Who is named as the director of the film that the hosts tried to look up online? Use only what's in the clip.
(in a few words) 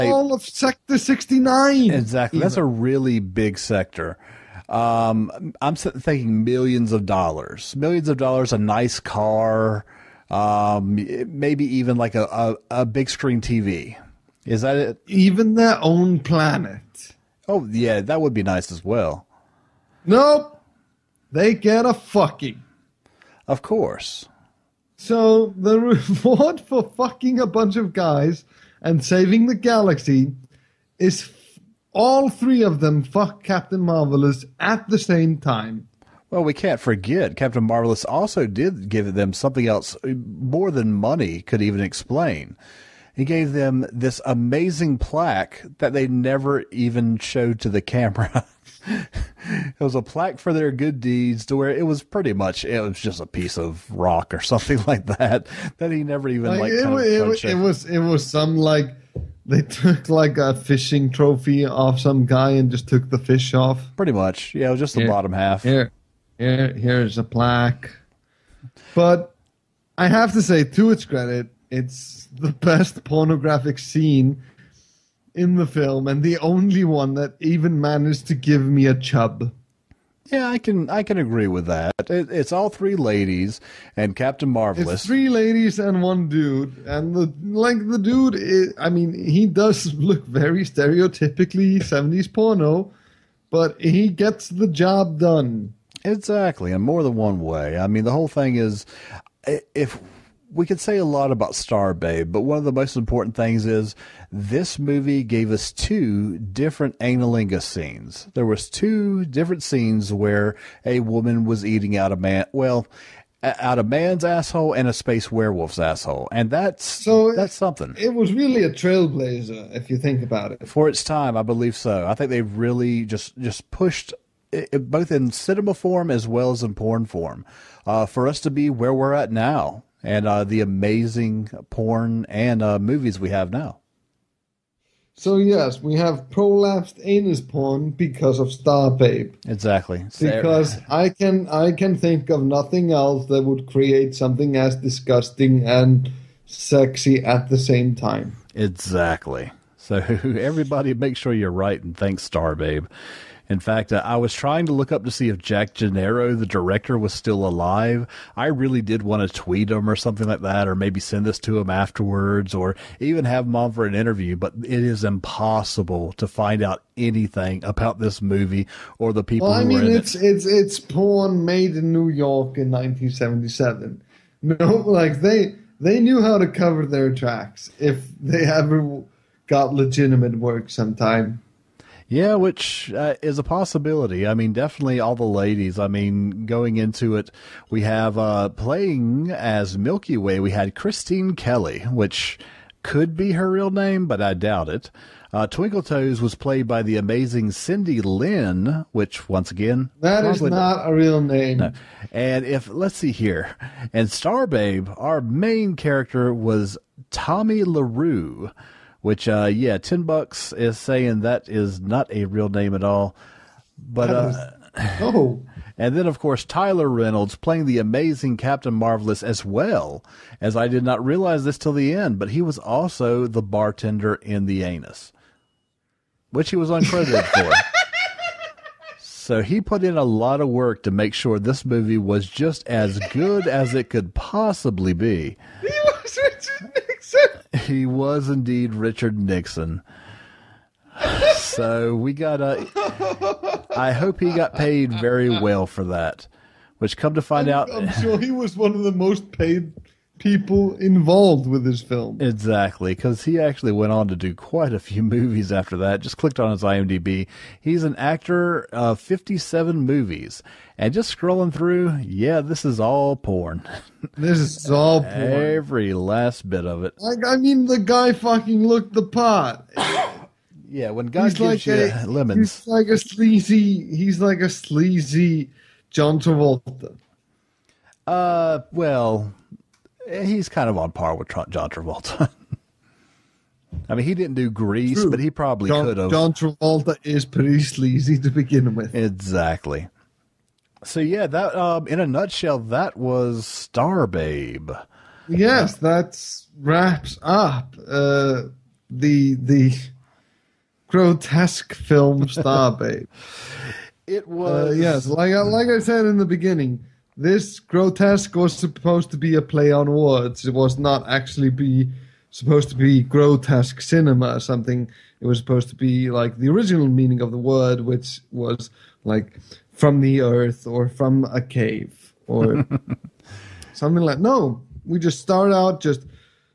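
Jack Gennaro.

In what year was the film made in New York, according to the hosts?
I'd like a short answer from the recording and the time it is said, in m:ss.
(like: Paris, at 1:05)
1977, at 2:52.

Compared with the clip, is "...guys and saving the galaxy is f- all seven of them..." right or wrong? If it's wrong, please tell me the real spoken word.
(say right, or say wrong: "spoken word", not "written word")
wrong: "three", not "seven".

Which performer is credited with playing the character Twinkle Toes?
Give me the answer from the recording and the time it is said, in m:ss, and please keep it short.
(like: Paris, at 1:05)
Cindy Lynn, at 3:17.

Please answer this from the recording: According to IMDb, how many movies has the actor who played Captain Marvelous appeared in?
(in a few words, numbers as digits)
57.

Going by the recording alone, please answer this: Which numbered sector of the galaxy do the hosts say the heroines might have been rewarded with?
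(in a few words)
Sector 69.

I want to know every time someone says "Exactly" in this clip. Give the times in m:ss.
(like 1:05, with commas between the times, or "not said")
0:01, 1:36, 2:19, 2:28, 4:12, 4:48.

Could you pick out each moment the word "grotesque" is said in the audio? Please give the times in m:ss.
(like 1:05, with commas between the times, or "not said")
5:00, 5:07, 5:13.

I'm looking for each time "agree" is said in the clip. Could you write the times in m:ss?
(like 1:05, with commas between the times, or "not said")
1:21.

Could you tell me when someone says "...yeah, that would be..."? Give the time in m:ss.
0:17.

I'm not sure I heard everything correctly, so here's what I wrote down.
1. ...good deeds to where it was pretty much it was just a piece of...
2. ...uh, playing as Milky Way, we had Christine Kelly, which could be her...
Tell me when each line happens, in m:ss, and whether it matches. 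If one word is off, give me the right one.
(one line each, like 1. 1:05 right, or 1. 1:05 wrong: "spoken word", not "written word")
1. 0:50 right
2. 3:08 right.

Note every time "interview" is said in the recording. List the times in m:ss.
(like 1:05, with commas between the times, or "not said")
2:43.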